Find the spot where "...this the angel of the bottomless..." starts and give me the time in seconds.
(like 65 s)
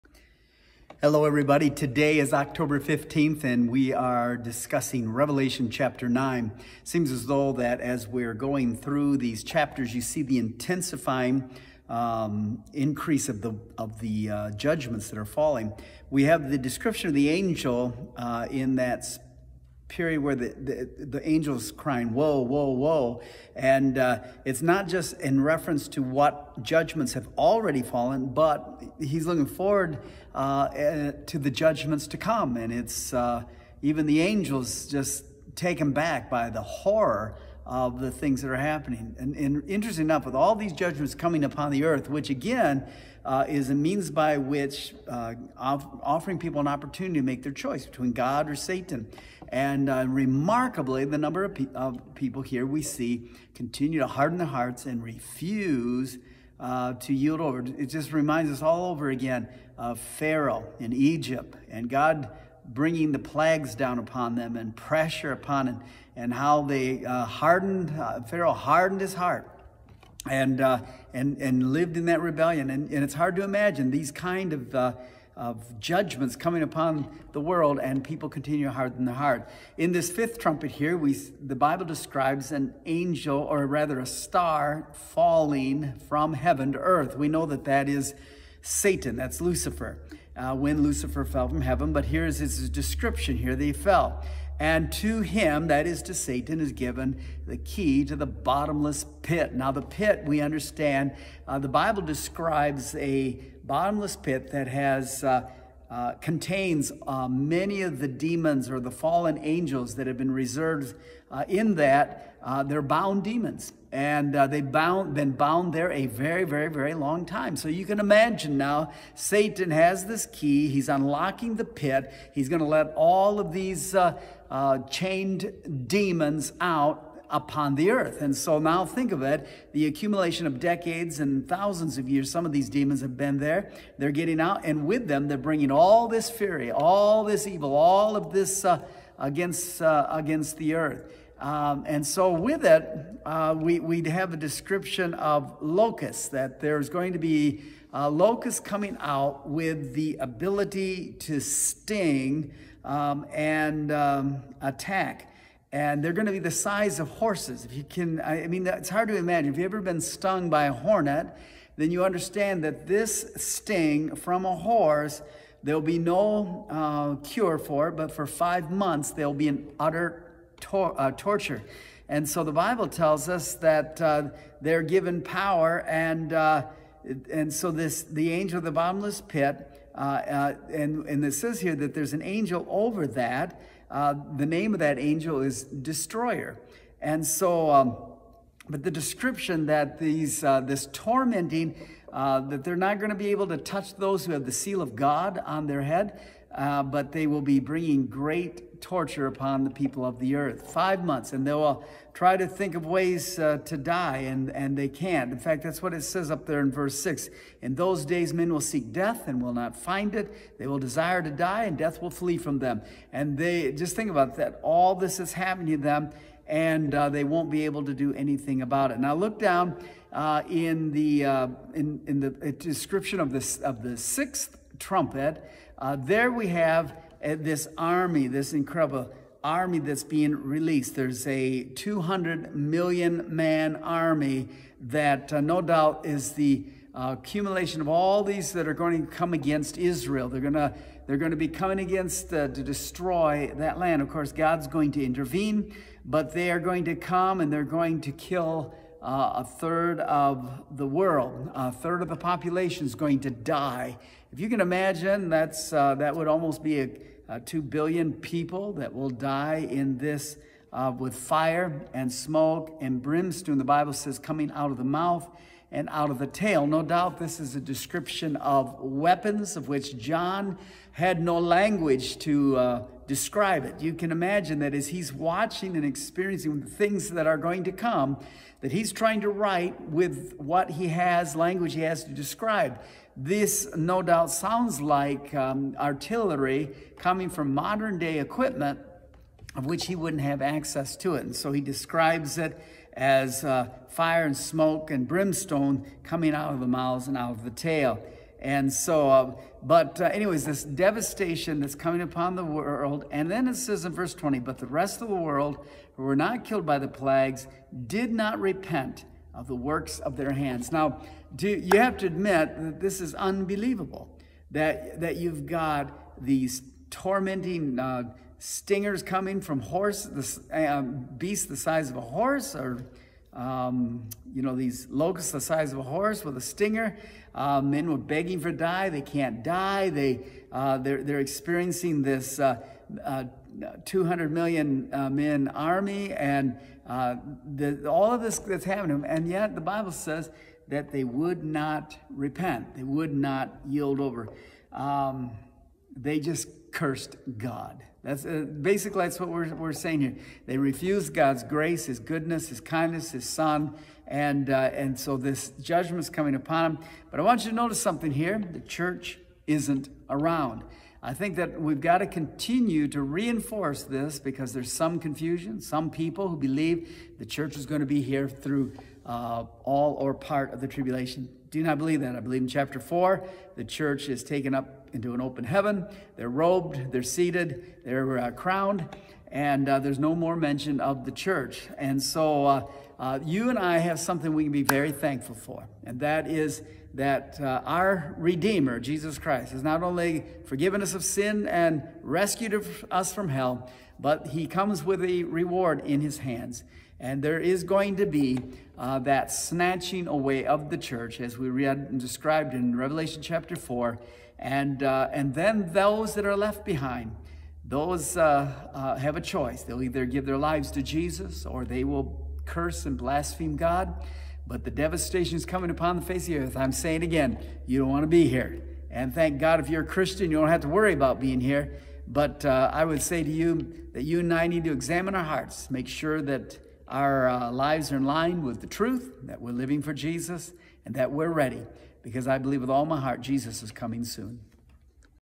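177 s.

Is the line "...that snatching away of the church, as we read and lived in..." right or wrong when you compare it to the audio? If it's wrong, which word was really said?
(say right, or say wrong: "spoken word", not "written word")
wrong: "described", not "lived".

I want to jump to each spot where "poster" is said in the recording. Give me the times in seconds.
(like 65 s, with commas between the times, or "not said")
not said.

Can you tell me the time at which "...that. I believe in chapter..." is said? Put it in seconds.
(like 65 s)
372 s.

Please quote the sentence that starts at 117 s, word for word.
So you can imagine now, Satan has this key.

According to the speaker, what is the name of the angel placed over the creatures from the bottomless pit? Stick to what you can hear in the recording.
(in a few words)
Destroyer.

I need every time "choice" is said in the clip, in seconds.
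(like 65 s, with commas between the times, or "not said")
47 s, 409 s.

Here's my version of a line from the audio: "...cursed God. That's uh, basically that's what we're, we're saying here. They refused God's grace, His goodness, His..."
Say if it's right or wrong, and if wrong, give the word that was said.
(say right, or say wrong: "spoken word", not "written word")
right.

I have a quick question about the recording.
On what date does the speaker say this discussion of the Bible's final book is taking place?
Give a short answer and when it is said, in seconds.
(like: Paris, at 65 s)
October 15th, at 2 s.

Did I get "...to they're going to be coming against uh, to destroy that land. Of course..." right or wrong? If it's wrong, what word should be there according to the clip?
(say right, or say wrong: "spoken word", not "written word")
right.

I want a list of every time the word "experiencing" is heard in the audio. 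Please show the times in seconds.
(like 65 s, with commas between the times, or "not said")
275 s, 331 s.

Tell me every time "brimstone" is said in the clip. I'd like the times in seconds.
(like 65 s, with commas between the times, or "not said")
263 s, 295 s.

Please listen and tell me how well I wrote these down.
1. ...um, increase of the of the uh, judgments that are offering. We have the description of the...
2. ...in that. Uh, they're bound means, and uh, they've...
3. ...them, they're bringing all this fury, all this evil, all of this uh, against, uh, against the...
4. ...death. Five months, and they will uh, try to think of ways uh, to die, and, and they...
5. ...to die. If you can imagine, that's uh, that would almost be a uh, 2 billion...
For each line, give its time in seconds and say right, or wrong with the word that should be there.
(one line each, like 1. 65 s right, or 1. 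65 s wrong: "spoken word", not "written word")
1. 11 s wrong: "falling", not "offering"
2. 111 s wrong: "demons", not "means"
3. 135 s right
4. 200 s wrong: "earth", not "death"
5. 253 s right.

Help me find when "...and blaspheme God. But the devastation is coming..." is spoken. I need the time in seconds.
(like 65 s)
412 s.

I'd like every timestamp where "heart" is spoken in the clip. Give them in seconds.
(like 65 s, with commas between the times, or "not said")
54 s, 69 s, 79 s, 425 s, 432 s.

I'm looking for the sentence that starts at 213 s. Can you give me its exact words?
And they just think about that.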